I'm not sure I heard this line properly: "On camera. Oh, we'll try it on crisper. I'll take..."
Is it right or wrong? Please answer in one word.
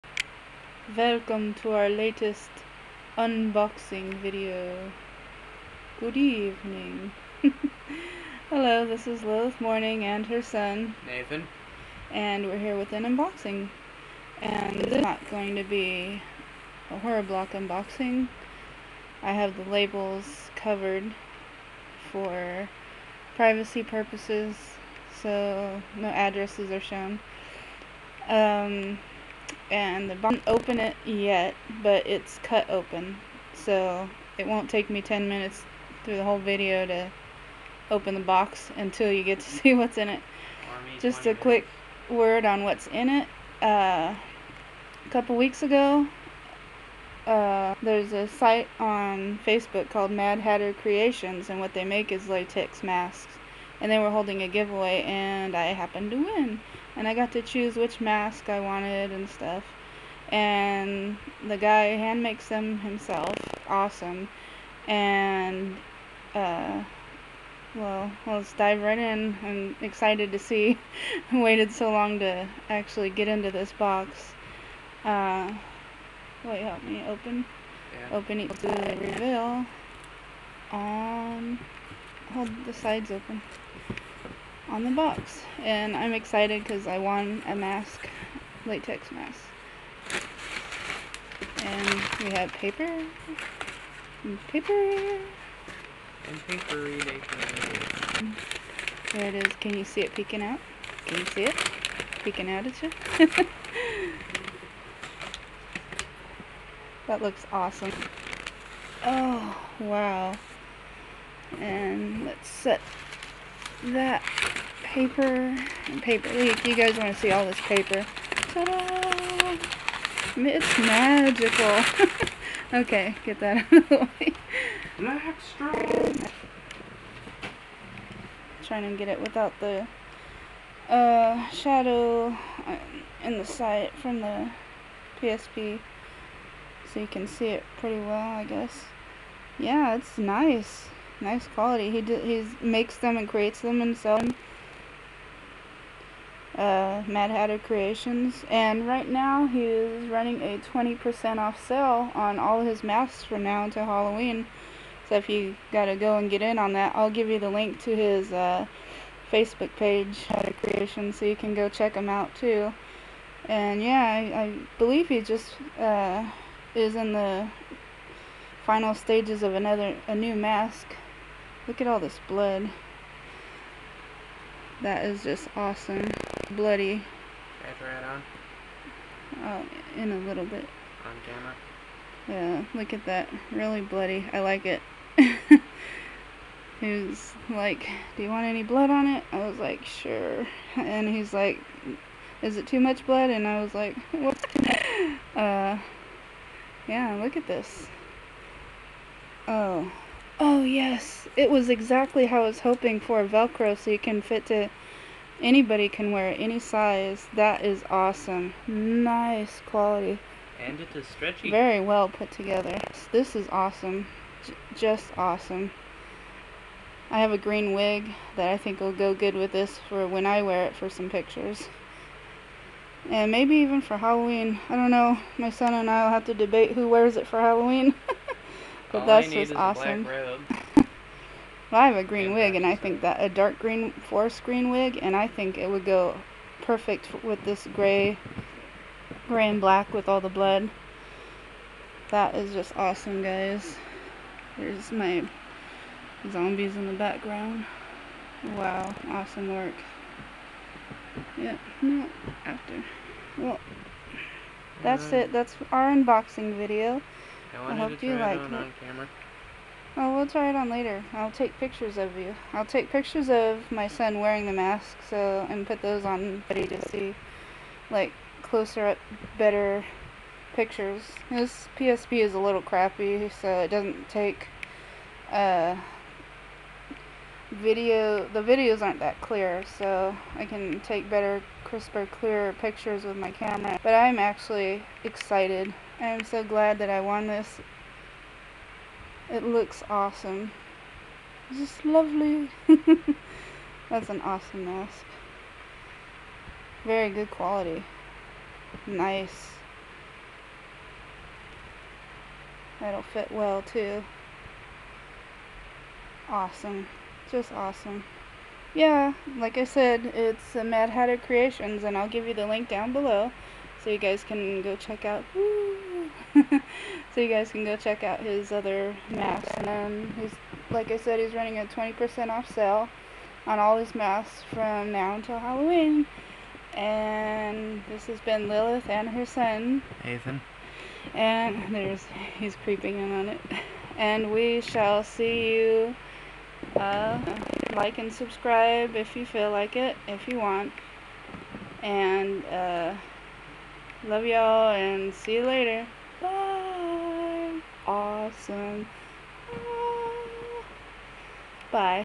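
wrong.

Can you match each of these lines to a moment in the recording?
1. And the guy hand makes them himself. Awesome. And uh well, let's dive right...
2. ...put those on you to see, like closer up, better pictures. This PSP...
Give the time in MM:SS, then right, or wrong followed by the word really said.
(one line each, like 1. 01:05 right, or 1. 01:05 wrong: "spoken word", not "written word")
1. 01:00 right
2. 04:25 right.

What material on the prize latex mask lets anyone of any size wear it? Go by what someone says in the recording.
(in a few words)
Velcro.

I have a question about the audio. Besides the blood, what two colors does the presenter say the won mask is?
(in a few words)
Gray and black.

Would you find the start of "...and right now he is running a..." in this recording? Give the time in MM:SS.
02:28.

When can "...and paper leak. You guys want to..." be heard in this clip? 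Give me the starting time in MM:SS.
01:55.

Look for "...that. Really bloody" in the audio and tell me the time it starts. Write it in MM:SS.
03:03.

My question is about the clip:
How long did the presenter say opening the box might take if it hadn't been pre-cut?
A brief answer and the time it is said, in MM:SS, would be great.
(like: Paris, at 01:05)
10 minutes, at 00:35.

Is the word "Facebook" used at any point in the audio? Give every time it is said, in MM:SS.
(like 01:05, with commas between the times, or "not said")
00:49, 02:39.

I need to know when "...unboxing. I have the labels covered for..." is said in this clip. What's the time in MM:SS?
00:17.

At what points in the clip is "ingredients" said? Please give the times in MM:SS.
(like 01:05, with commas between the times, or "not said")
not said.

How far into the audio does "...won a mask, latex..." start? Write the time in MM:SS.
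01:26.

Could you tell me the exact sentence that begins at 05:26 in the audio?
And this has been Lilith and her son, Ethan.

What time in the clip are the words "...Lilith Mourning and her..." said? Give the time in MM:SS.
00:09.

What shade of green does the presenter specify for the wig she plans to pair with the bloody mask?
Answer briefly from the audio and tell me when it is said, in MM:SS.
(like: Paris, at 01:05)
Forest green, at 03:53.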